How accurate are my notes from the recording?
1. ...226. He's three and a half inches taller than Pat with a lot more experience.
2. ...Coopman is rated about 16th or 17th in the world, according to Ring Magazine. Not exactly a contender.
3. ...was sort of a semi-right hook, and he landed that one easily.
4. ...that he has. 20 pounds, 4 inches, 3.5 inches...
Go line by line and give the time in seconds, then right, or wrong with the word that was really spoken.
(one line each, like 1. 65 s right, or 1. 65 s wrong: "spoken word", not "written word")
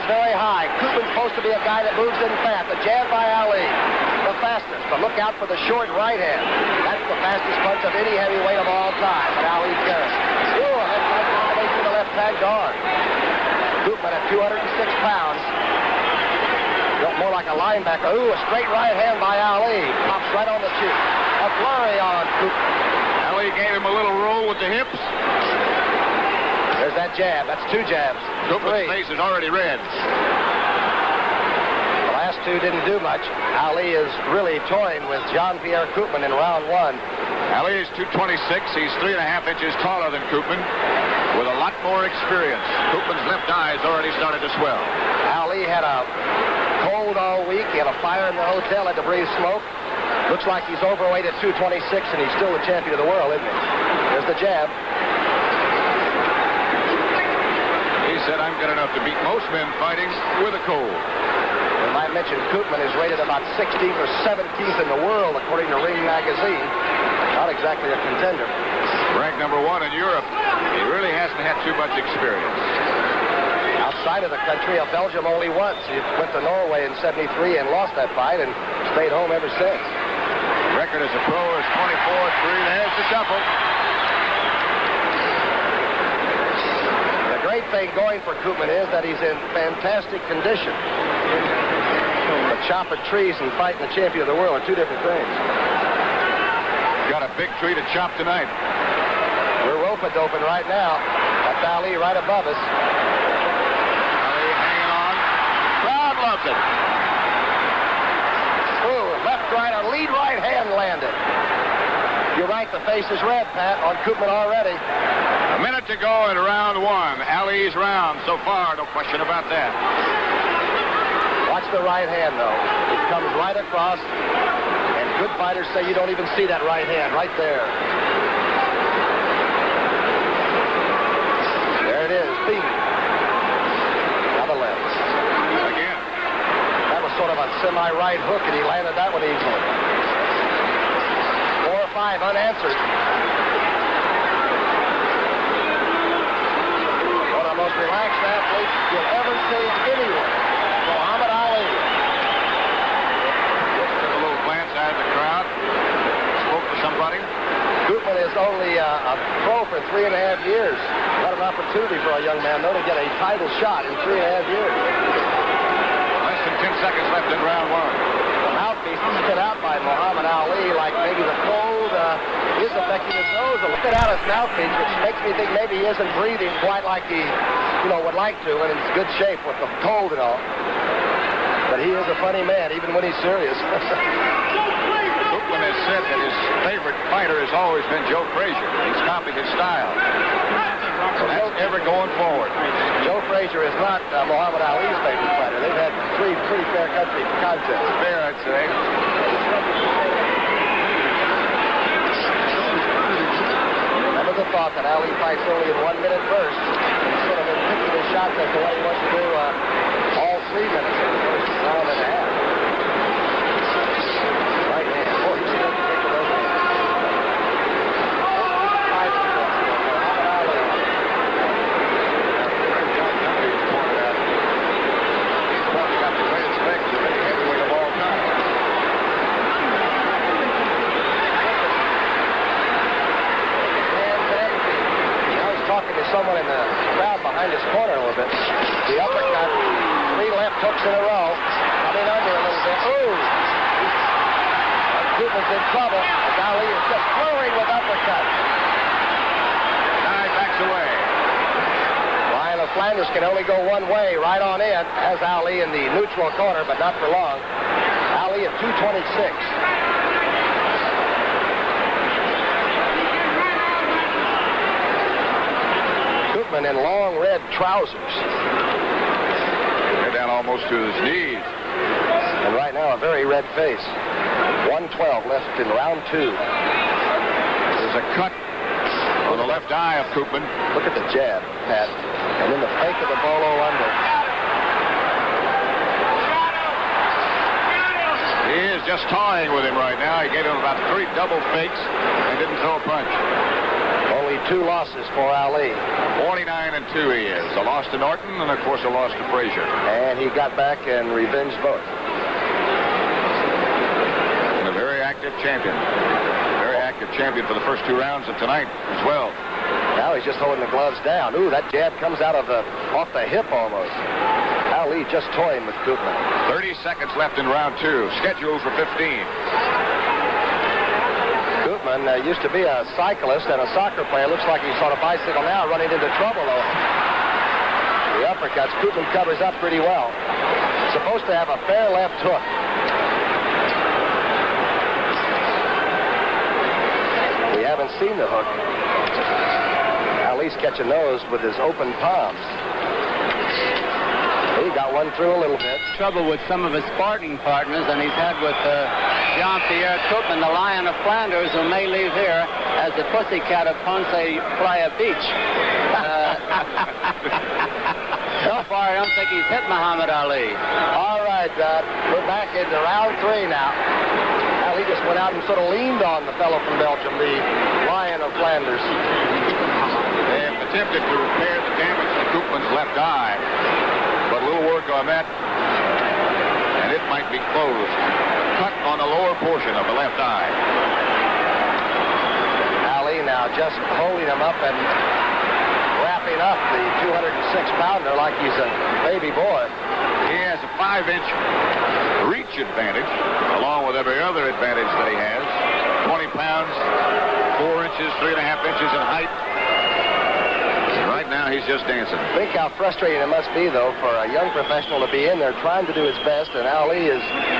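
1. 37 s wrong: "Coopman", not "Pat"
2. 62 s right
3. 137 s right
4. 394 s right.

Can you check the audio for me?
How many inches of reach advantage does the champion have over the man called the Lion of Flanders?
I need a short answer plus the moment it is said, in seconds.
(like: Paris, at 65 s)
5, at 390 s.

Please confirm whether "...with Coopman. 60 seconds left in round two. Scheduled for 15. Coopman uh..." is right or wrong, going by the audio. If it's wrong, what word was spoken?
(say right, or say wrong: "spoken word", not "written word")
wrong: "30", not "60".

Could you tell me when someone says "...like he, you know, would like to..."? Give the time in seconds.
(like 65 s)
176 s.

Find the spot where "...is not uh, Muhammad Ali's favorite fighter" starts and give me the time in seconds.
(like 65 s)
193 s.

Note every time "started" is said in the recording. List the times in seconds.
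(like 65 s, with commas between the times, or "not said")
44 s.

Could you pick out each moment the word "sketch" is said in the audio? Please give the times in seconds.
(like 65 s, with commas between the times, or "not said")
not said.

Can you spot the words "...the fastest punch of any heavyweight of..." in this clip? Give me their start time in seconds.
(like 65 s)
7 s.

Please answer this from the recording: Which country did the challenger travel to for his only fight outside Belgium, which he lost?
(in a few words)
Norway.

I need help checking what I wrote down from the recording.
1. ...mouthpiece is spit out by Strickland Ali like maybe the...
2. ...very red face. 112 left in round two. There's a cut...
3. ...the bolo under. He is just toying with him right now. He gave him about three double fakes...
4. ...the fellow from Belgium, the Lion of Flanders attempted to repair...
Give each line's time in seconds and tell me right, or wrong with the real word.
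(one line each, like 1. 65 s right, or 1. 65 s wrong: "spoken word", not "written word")
1. 168 s wrong: "Muhammad", not "Strickland"
2. 273 s right
3. 283 s right
4. 366 s right.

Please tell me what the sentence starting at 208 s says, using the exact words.
That's the way he wants to do uh, all three minutes in the first round and a half.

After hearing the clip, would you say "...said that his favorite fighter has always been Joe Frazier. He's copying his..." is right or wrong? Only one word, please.
right.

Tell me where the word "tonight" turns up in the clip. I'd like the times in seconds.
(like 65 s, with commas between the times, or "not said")
98 s, 308 s.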